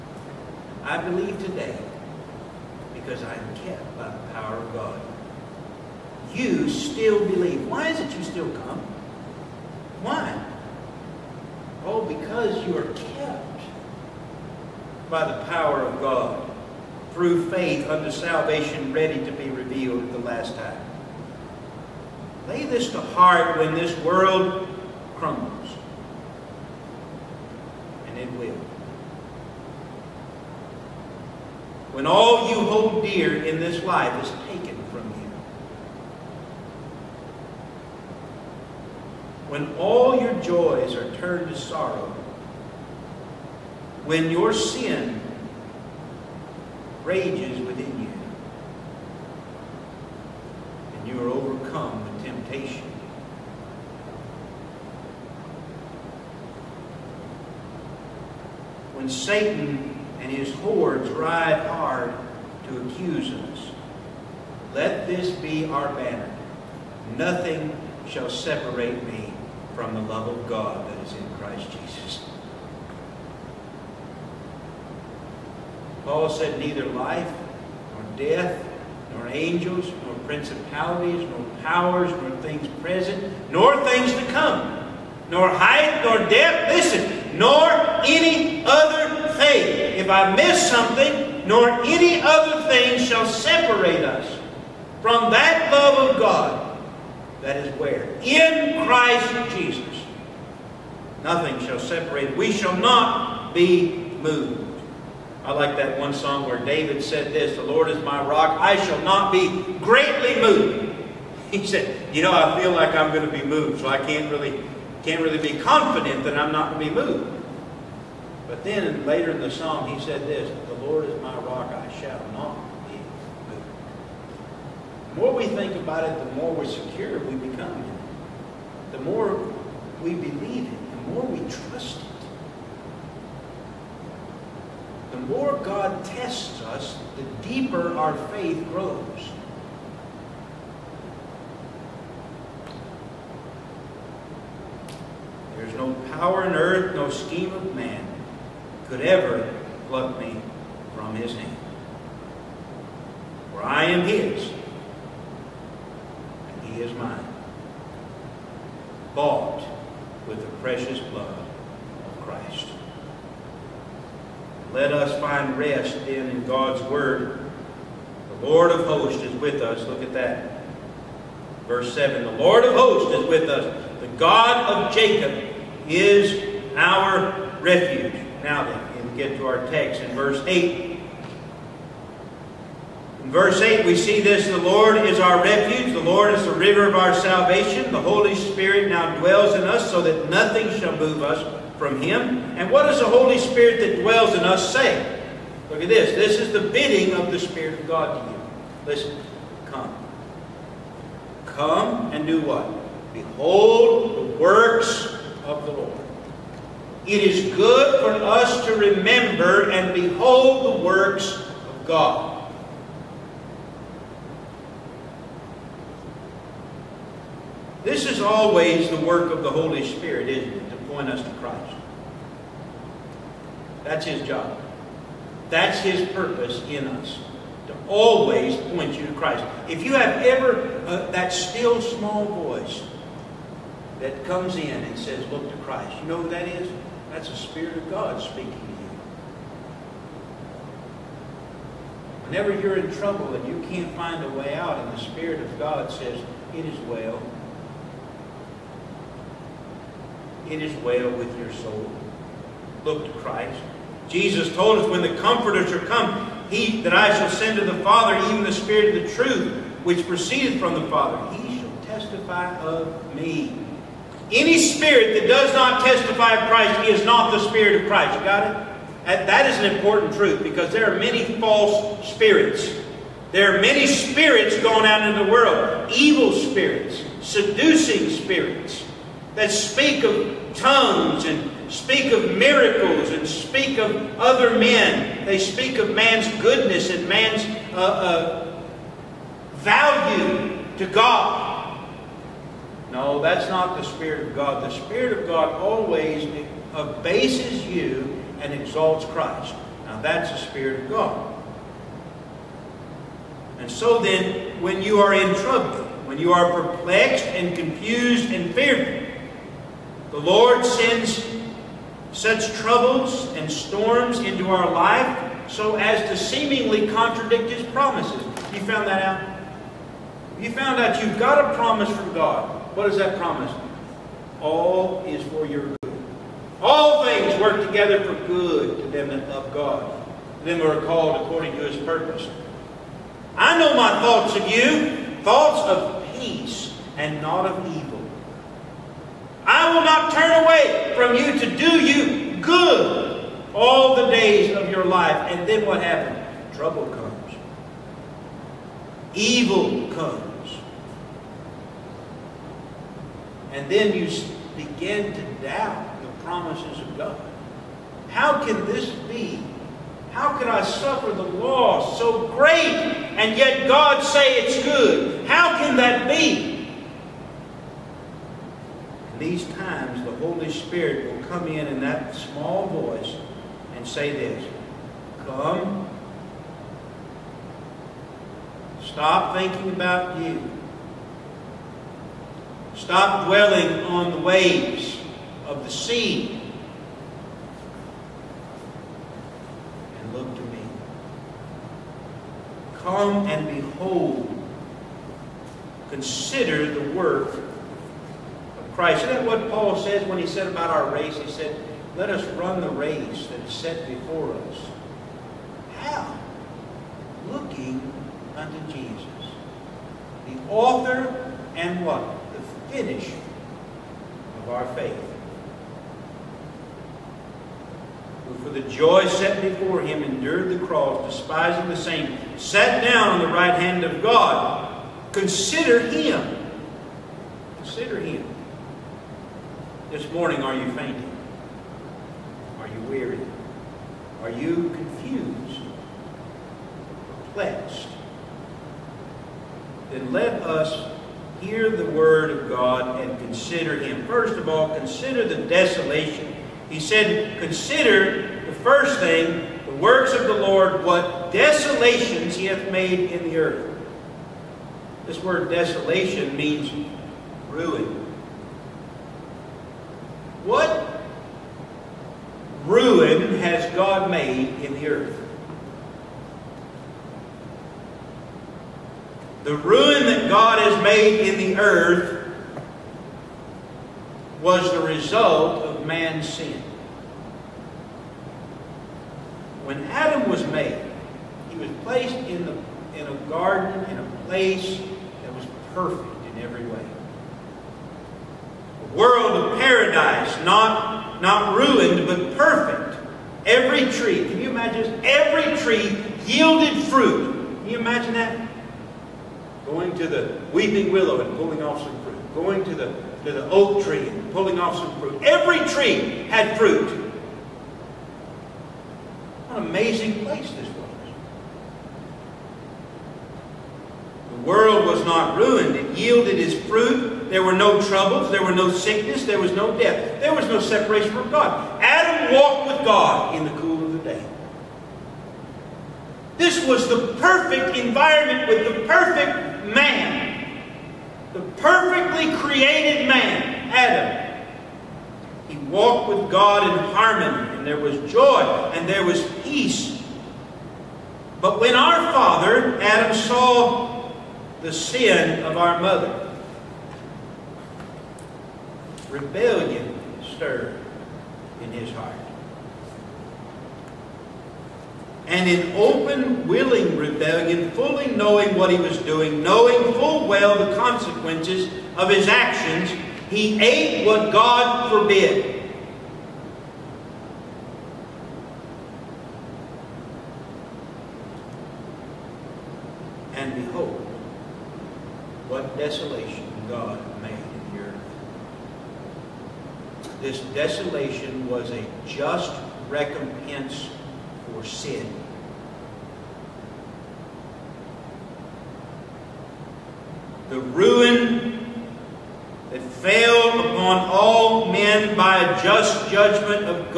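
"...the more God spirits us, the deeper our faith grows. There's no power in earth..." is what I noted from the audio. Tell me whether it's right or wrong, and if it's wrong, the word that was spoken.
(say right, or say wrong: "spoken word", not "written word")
wrong: "tests", not "spirits".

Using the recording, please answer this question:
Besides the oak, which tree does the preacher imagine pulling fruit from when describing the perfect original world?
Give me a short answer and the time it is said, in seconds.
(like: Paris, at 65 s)
Weeping willow, at 500 s.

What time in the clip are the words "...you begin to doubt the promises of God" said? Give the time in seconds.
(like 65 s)
353 s.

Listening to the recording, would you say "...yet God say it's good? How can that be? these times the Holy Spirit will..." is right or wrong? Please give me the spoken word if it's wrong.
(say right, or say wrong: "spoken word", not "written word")
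right.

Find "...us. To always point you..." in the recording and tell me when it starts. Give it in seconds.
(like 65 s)
226 s.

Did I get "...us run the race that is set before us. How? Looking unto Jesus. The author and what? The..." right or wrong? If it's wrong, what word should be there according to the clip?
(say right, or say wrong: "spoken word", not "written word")
right.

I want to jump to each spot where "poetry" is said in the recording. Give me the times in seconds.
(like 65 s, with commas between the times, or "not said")
not said.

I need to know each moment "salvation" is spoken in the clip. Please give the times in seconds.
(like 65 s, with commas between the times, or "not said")
18 s, 187 s.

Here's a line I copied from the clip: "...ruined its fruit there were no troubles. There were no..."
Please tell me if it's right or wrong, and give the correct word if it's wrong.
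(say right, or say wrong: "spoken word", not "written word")
wrong: "yielded", not "ruined".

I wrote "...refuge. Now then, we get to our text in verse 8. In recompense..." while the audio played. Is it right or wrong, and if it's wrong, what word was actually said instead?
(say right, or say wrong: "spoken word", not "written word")
wrong: "verse", not "recompense".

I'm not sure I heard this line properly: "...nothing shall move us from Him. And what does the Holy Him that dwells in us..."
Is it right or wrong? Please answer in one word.
wrong.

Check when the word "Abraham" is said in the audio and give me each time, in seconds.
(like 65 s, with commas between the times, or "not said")
not said.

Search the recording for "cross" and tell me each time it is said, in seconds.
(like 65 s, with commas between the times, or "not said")
420 s.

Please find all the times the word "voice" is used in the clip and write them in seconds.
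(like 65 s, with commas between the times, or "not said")
232 s, 372 s.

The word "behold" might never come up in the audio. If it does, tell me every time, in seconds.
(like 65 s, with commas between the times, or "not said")
203 s, 209 s, 393 s.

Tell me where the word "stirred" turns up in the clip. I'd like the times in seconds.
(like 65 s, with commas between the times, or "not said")
550 s.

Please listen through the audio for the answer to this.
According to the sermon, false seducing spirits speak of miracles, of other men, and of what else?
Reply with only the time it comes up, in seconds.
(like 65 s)
280 s.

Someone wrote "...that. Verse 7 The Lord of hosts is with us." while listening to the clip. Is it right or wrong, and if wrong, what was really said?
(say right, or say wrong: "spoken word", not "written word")
right.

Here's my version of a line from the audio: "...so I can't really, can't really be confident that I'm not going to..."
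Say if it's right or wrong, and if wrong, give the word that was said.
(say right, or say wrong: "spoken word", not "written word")
right.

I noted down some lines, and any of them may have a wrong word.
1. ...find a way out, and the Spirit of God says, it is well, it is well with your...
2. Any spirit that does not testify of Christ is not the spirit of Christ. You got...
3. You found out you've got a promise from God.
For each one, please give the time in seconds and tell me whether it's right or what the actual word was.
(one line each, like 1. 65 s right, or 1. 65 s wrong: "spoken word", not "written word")
1. 243 s right
2. 264 s right
3. 320 s right.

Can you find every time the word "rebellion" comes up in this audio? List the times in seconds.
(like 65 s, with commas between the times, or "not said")
549 s, 556 s.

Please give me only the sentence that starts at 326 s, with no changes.
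All things work together for good to them that love God, them who are called according to His purpose.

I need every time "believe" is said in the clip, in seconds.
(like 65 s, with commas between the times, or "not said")
1 s, 7 s, 130 s.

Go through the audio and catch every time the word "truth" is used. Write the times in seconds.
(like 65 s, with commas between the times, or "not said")
259 s, 270 s.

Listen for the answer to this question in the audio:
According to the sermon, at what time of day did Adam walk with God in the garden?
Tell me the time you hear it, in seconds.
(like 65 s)
523 s.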